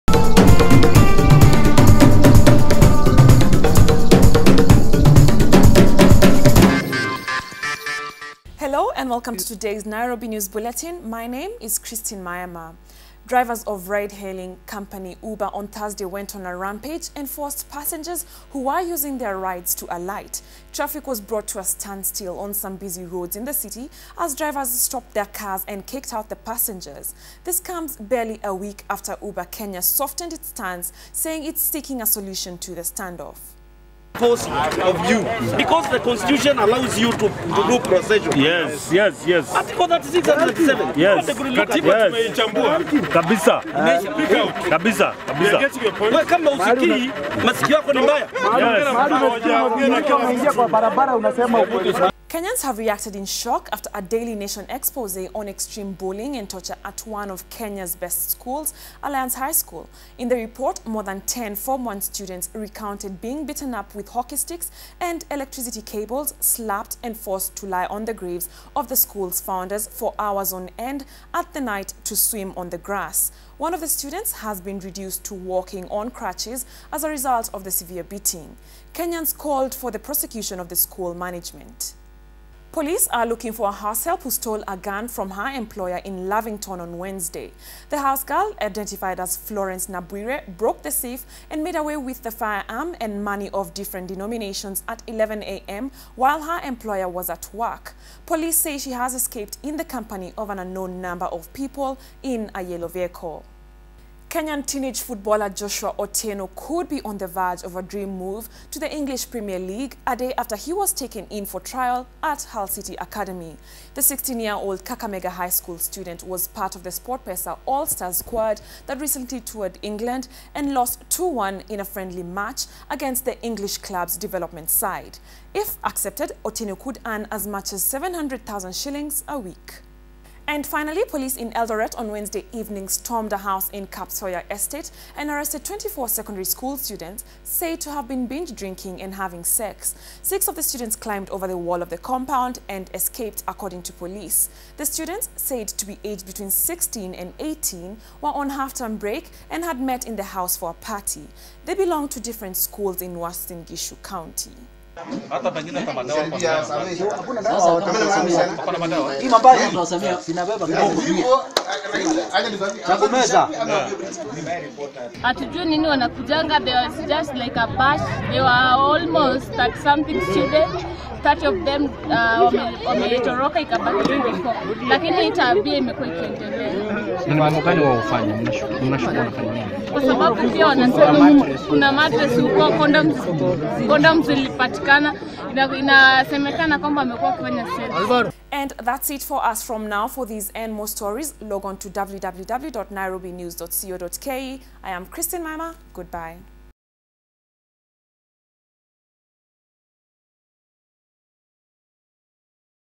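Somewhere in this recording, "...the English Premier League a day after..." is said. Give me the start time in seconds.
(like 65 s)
108 s.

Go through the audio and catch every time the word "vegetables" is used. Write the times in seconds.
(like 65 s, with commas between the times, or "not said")
not said.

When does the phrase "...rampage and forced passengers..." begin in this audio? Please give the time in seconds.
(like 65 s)
16 s.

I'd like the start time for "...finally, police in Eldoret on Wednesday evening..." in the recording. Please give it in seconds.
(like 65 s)
130 s.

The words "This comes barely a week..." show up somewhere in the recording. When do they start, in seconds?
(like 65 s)
27 s.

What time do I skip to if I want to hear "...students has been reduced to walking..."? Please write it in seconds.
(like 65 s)
73 s.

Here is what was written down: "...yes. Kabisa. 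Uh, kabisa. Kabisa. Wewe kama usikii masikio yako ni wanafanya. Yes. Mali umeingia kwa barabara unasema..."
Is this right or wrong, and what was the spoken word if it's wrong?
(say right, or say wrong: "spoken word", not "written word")
wrong: "mbaya", not "wanafanya".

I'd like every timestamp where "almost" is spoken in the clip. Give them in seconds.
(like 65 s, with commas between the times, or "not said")
168 s.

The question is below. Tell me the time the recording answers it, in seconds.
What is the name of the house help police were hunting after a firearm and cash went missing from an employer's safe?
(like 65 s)
89 s.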